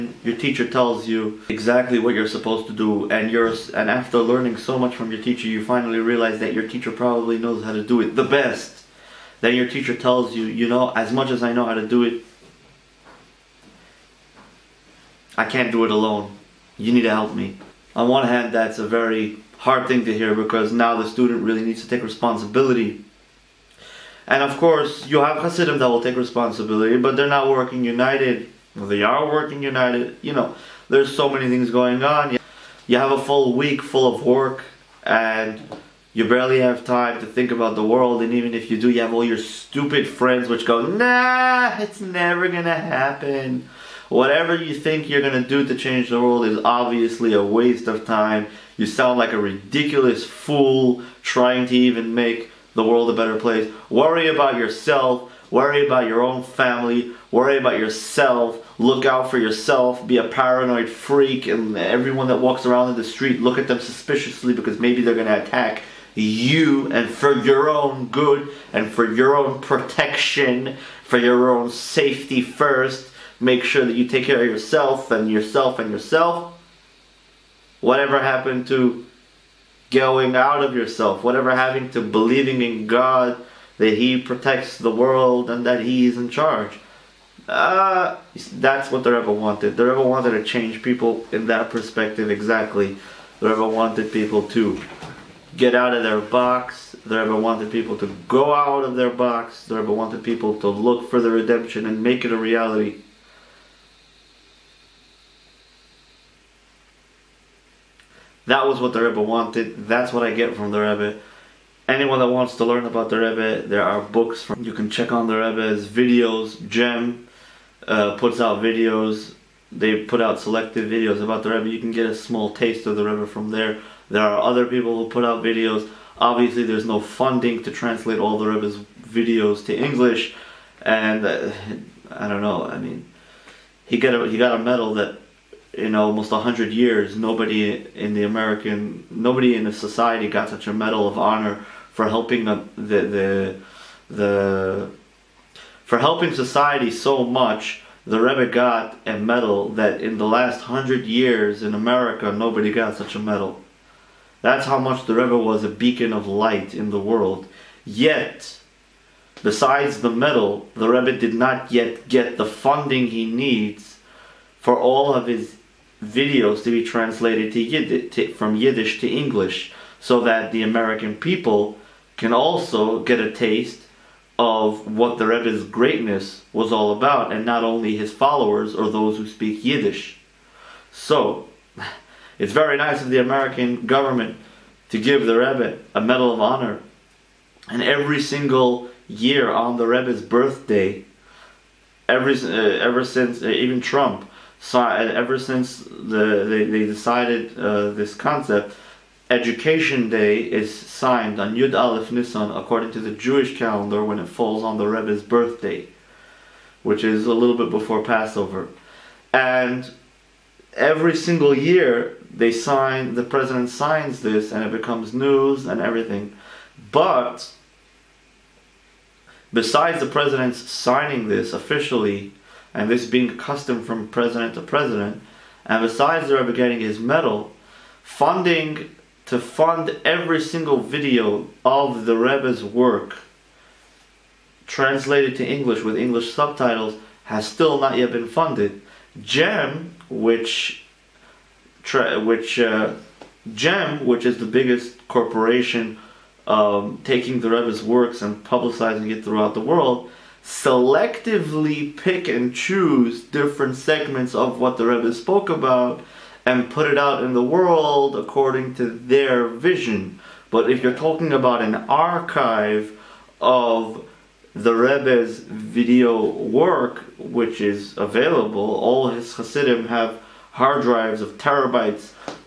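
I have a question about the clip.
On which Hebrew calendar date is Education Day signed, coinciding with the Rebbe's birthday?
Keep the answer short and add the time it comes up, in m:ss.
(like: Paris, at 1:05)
Yud Aleph Nisan, at 3:21.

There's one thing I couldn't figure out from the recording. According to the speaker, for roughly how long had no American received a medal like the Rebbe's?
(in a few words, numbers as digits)
100 years.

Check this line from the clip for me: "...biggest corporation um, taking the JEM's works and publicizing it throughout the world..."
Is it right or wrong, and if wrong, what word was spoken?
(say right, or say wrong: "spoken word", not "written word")
wrong: "Rebbe", not "JEM".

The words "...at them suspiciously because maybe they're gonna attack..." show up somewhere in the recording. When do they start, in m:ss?
1:03.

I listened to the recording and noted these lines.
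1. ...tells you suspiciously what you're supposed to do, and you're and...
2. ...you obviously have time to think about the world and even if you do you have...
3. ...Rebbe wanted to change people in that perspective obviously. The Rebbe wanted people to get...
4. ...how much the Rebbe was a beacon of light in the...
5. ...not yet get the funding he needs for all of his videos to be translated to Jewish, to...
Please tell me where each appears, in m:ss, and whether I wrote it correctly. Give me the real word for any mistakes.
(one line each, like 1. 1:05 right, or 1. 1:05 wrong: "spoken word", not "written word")
1. 0:00 wrong: "exactly", not "suspiciously"
2. 0:36 wrong: "barely", not "obviously"
3. 1:29 wrong: "exactly", not "obviously"
4. 2:34 right
5. 2:41 wrong: "Yiddish", not "Jewish".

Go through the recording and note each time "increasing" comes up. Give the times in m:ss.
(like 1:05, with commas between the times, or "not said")
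not said.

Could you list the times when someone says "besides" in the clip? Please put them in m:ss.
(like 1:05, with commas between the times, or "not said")
2:39, 3:39, 3:45.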